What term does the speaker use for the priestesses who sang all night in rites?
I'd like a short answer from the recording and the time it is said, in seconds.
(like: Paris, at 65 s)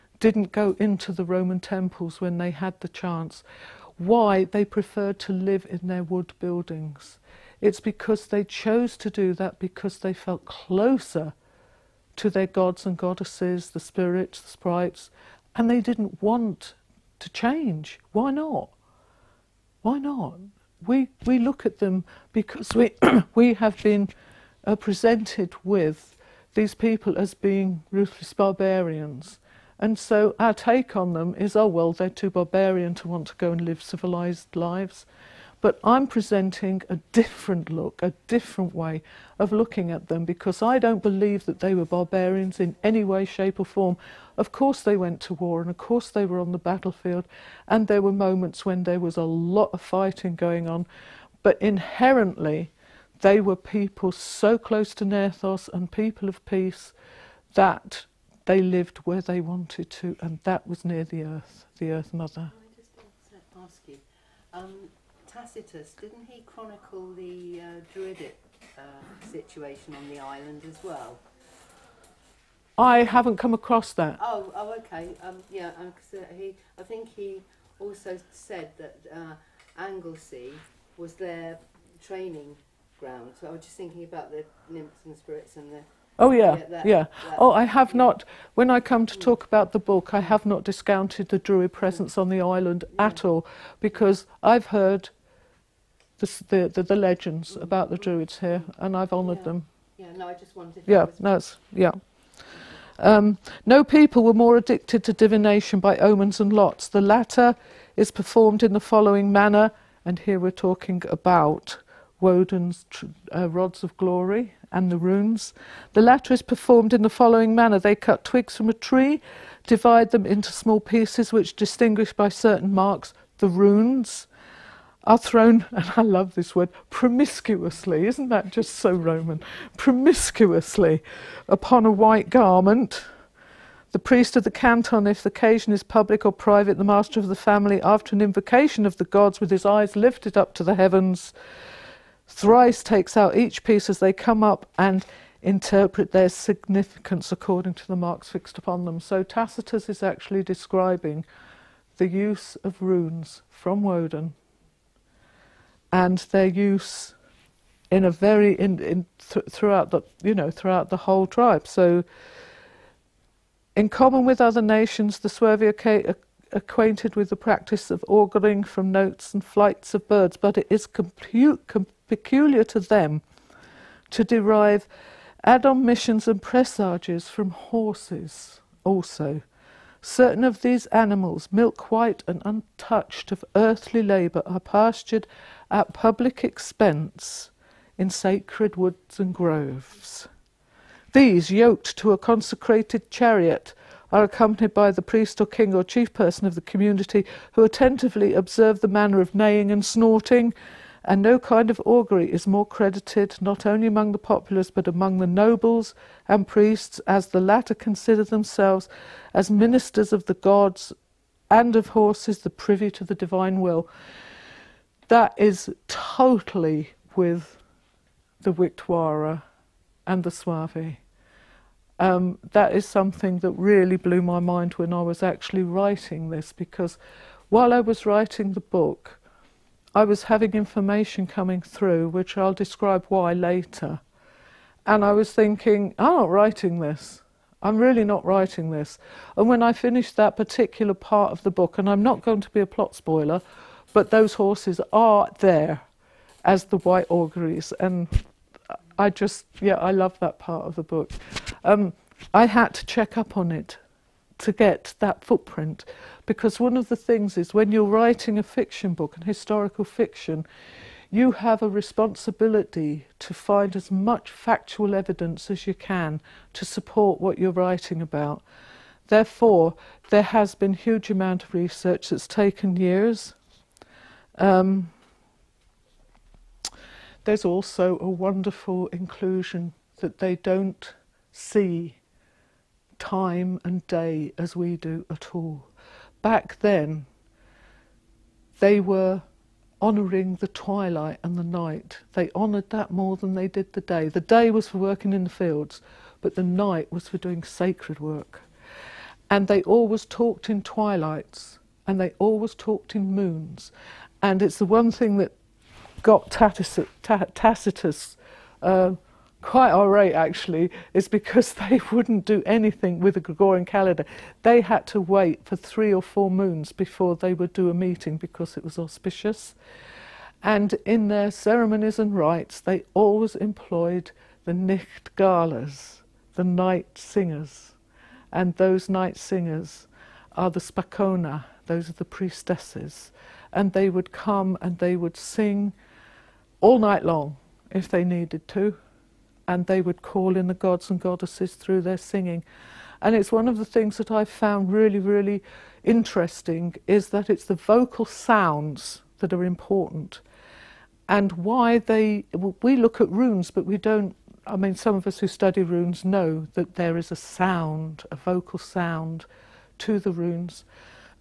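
spacona, at 330 s.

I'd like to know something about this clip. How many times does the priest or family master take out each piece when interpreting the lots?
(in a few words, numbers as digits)
3.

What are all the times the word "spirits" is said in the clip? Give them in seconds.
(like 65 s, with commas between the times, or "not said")
13 s, 85 s.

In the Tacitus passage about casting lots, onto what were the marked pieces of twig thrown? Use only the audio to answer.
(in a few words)
a white garment.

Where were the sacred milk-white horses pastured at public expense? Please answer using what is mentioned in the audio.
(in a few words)
sacred woods and groves.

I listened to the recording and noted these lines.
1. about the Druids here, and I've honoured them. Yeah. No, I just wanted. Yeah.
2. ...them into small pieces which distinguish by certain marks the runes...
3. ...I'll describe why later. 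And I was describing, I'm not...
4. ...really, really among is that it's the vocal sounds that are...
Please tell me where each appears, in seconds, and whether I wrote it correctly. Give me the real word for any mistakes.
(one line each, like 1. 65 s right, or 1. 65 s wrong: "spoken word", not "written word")
1. 97 s right
2. 120 s right
3. 232 s wrong: "thinking", not "describing"
4. 344 s wrong: "interesting", not "among".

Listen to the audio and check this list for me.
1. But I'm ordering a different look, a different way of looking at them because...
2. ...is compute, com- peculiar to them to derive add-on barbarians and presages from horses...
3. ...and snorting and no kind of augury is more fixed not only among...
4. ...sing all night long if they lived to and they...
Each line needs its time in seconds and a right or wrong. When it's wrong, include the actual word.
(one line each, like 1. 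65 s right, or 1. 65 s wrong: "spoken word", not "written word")
1. 35 s wrong: "presenting", not "ordering"
2. 170 s wrong: "missions", not "barbarians"
3. 199 s wrong: "credited", not "fixed"
4. 335 s wrong: "needed", not "lived".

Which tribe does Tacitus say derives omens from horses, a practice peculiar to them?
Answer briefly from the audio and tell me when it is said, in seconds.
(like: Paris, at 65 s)
Suevi, at 165 s.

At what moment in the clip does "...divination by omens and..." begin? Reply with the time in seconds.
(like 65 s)
105 s.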